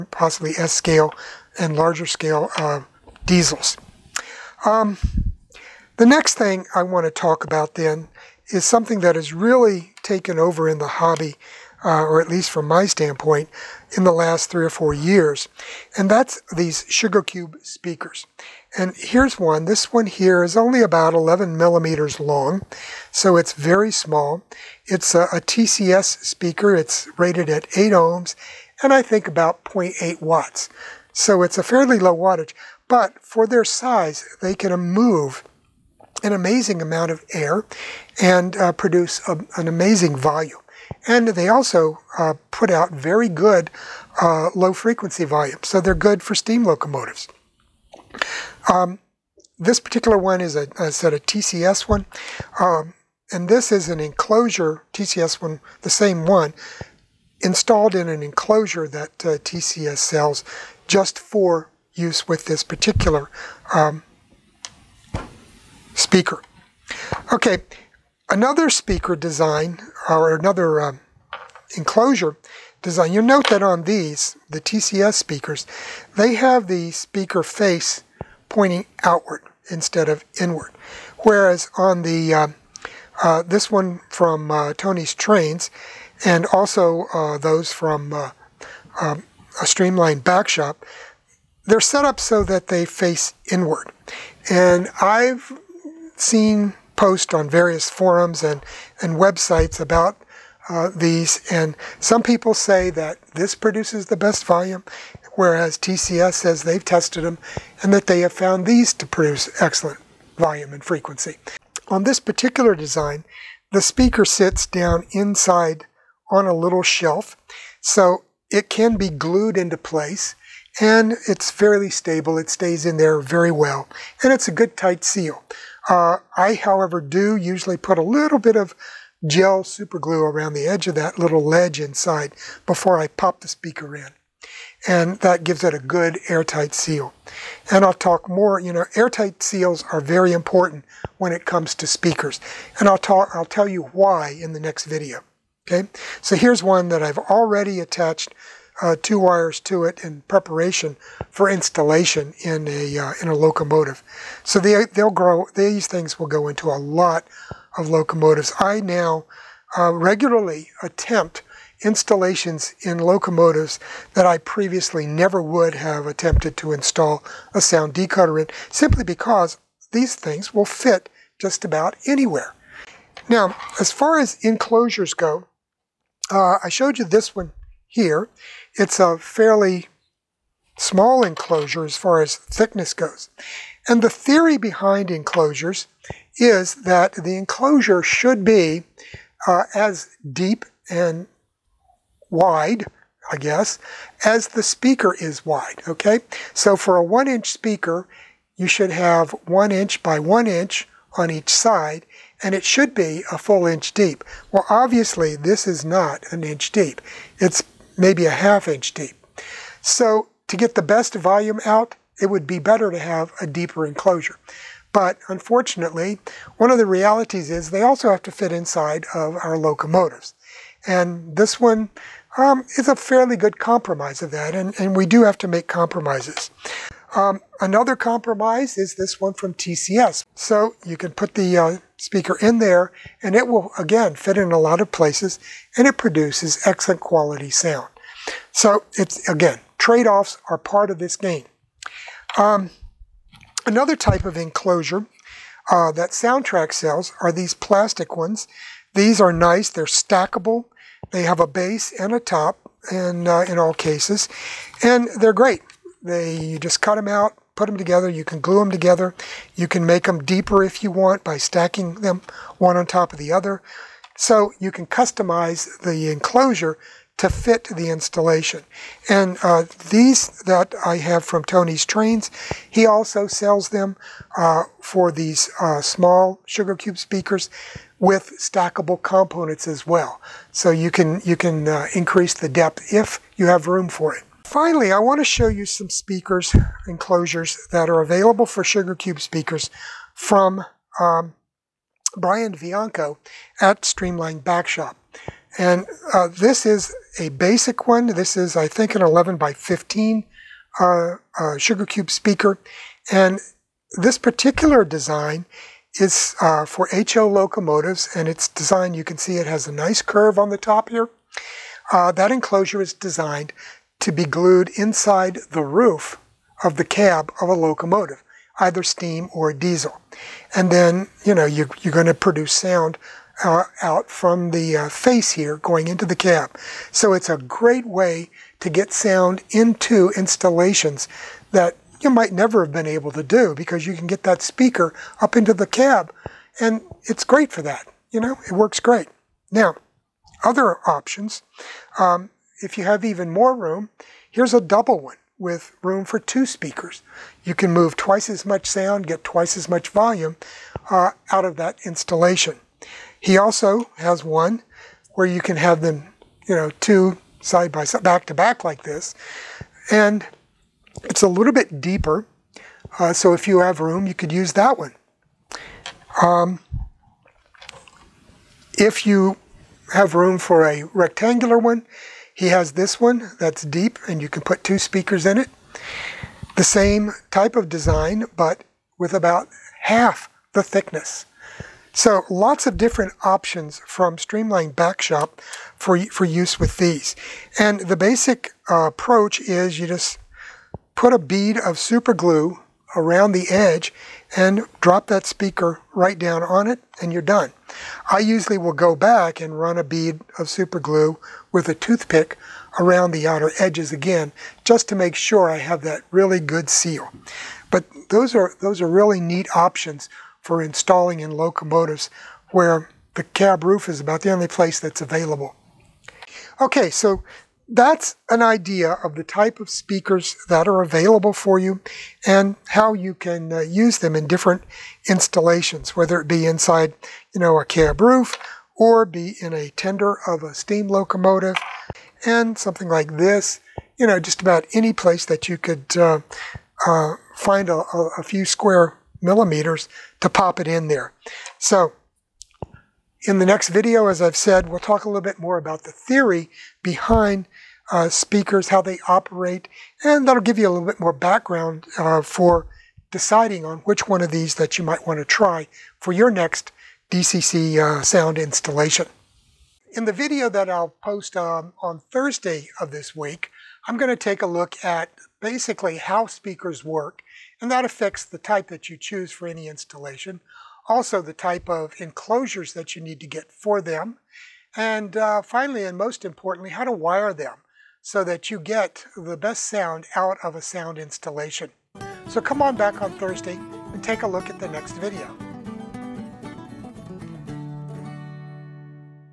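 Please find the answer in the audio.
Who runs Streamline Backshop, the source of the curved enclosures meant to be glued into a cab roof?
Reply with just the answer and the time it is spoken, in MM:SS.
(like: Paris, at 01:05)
Brian Bianco, at 04:52.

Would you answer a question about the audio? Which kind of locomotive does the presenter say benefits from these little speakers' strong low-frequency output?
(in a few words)
steam locomotives.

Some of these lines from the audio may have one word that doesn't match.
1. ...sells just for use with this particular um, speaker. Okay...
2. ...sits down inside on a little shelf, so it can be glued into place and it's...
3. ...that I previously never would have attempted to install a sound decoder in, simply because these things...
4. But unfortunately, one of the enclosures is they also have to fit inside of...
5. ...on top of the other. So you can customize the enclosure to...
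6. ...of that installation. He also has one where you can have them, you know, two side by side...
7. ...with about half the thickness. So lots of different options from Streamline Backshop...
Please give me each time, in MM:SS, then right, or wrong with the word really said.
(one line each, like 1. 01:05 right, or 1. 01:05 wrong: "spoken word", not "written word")
1. 00:59 right
2. 01:54 right
3. 02:44 right
4. 03:34 wrong: "realities", not "enclosures"
5. 04:22 right
6. 05:51 right
7. 06:18 right.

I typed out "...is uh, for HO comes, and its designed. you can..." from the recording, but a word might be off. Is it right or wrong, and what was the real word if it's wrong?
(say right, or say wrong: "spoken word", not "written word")
wrong: "locomotives", not "comes".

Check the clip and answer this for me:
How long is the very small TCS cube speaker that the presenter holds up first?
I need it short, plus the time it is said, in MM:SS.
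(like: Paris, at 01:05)
11 millimeters, at 00:21.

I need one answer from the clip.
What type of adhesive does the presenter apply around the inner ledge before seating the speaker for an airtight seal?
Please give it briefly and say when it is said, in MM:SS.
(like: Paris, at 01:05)
gel super glue, at 02:09.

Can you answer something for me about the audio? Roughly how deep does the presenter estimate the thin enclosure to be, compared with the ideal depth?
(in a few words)
half inch.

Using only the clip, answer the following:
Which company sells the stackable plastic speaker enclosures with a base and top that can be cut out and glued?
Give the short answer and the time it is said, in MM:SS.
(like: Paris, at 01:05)
Soundtraxx, at 04:06.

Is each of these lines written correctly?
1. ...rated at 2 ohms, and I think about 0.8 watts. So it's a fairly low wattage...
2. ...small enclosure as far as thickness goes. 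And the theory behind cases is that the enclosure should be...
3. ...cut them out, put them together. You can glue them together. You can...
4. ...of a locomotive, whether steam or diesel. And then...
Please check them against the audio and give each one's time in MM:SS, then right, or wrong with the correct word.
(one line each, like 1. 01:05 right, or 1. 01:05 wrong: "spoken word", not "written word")
1. 00:27 wrong: "8", not "2"
2. 03:00 wrong: "enclosures", not "cases"
3. 04:16 right
4. 05:17 wrong: "either", not "whether".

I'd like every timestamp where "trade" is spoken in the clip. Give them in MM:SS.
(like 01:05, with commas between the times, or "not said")
03:59.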